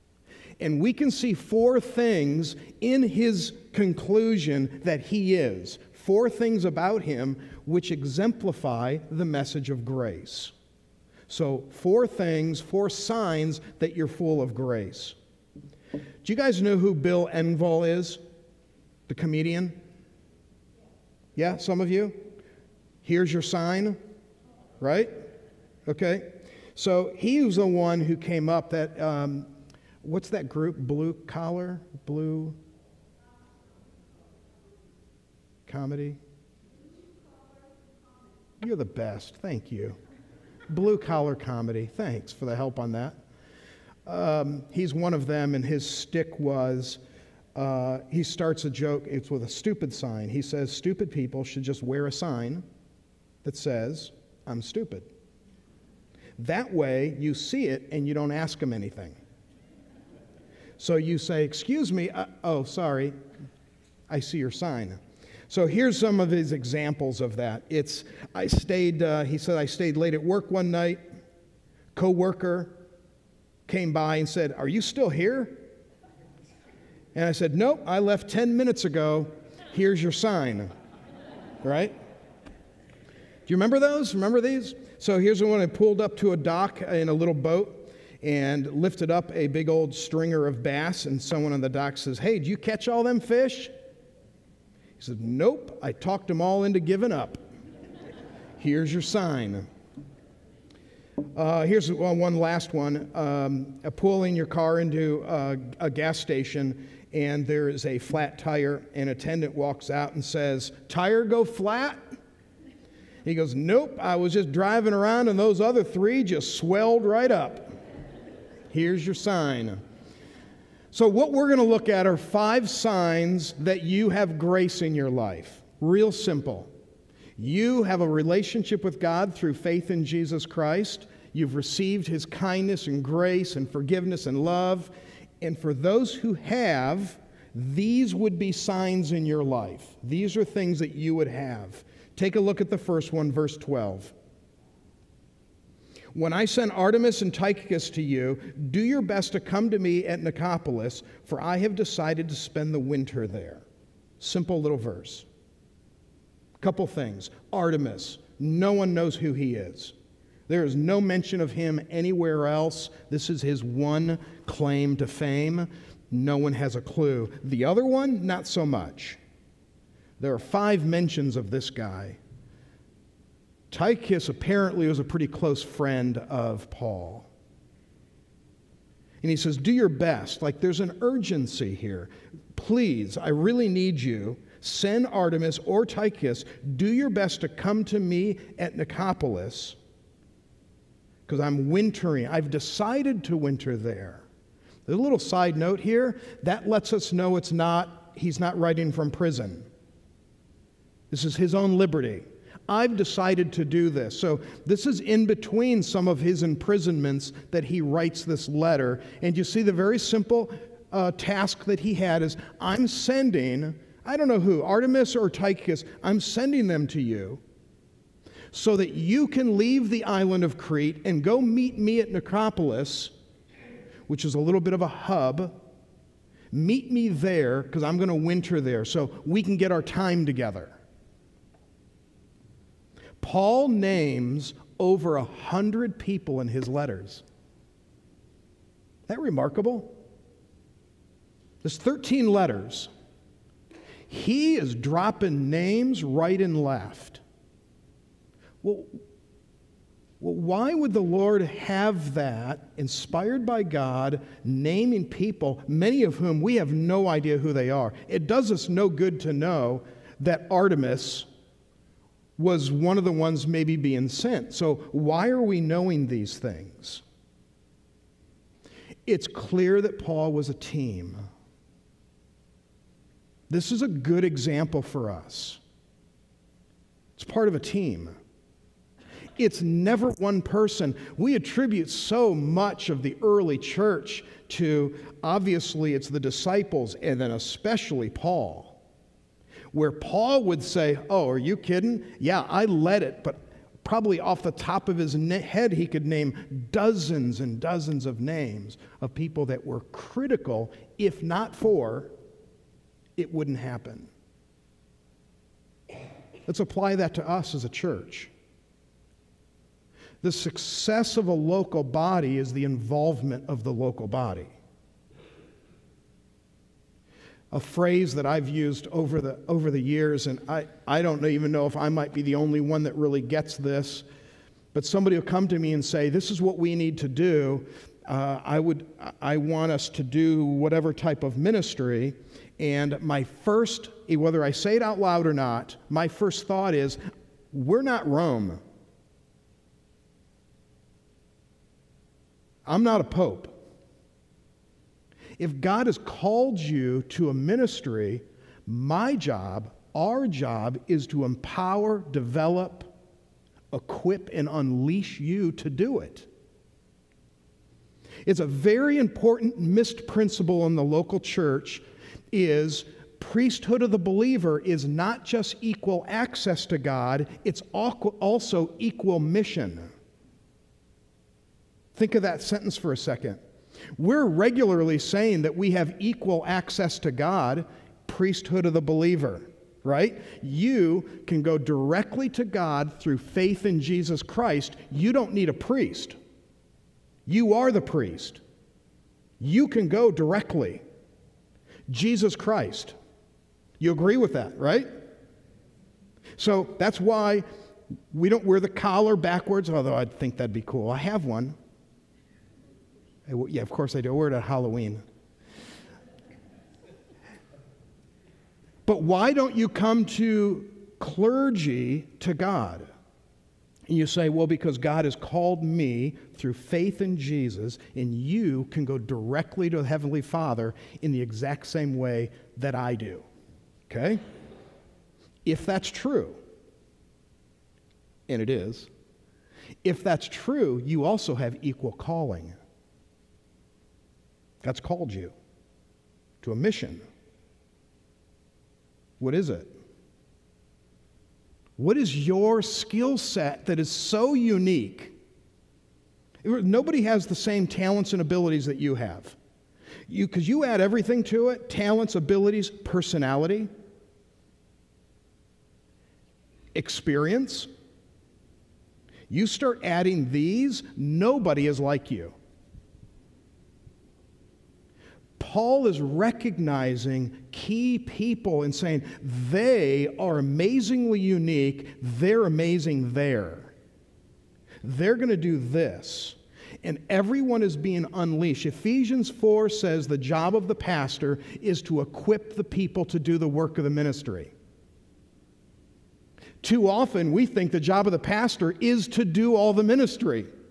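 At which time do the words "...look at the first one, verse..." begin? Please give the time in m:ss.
2:22.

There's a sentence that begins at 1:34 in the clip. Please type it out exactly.
He said, Nope, I talked them all into giving up.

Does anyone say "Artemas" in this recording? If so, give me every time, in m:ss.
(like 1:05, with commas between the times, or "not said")
2:26, 2:37, 3:05, 3:34, 4:20.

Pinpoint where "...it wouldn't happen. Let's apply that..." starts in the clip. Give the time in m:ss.
5:03.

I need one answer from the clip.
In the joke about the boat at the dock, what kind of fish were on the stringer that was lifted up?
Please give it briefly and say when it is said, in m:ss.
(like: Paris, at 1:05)
Bass, at 1:30.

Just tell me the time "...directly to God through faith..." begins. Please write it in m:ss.
6:21.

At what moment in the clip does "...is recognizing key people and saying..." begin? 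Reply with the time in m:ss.
7:45.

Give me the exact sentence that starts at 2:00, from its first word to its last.
So, what we're going to look at are five signs that you have grace in your life.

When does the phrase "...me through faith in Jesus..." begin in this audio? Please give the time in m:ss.
6:55.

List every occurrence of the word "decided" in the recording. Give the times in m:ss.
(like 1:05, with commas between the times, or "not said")
2:31, 3:12, 3:22.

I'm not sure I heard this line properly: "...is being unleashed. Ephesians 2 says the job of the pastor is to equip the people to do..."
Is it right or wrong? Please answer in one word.
wrong.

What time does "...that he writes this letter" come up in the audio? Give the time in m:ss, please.
3:27.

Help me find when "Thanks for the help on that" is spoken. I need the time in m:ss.
0:41.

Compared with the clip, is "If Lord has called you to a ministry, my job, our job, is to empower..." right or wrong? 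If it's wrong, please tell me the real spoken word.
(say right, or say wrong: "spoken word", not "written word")
wrong: "God", not "Lord".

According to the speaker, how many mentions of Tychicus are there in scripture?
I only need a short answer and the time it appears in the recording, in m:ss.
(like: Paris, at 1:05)
5, at 2:50.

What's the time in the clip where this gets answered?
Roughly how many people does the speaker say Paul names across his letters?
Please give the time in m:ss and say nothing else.
3:54.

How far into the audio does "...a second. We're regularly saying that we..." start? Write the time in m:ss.
6:12.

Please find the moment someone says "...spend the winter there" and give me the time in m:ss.
2:32.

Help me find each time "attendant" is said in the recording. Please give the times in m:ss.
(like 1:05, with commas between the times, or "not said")
1:49.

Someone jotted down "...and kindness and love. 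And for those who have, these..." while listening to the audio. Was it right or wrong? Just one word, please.
wrong.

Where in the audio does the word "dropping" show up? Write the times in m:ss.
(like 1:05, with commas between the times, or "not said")
4:04.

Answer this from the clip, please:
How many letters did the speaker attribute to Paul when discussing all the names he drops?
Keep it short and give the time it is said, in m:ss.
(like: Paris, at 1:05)
13, at 4:01.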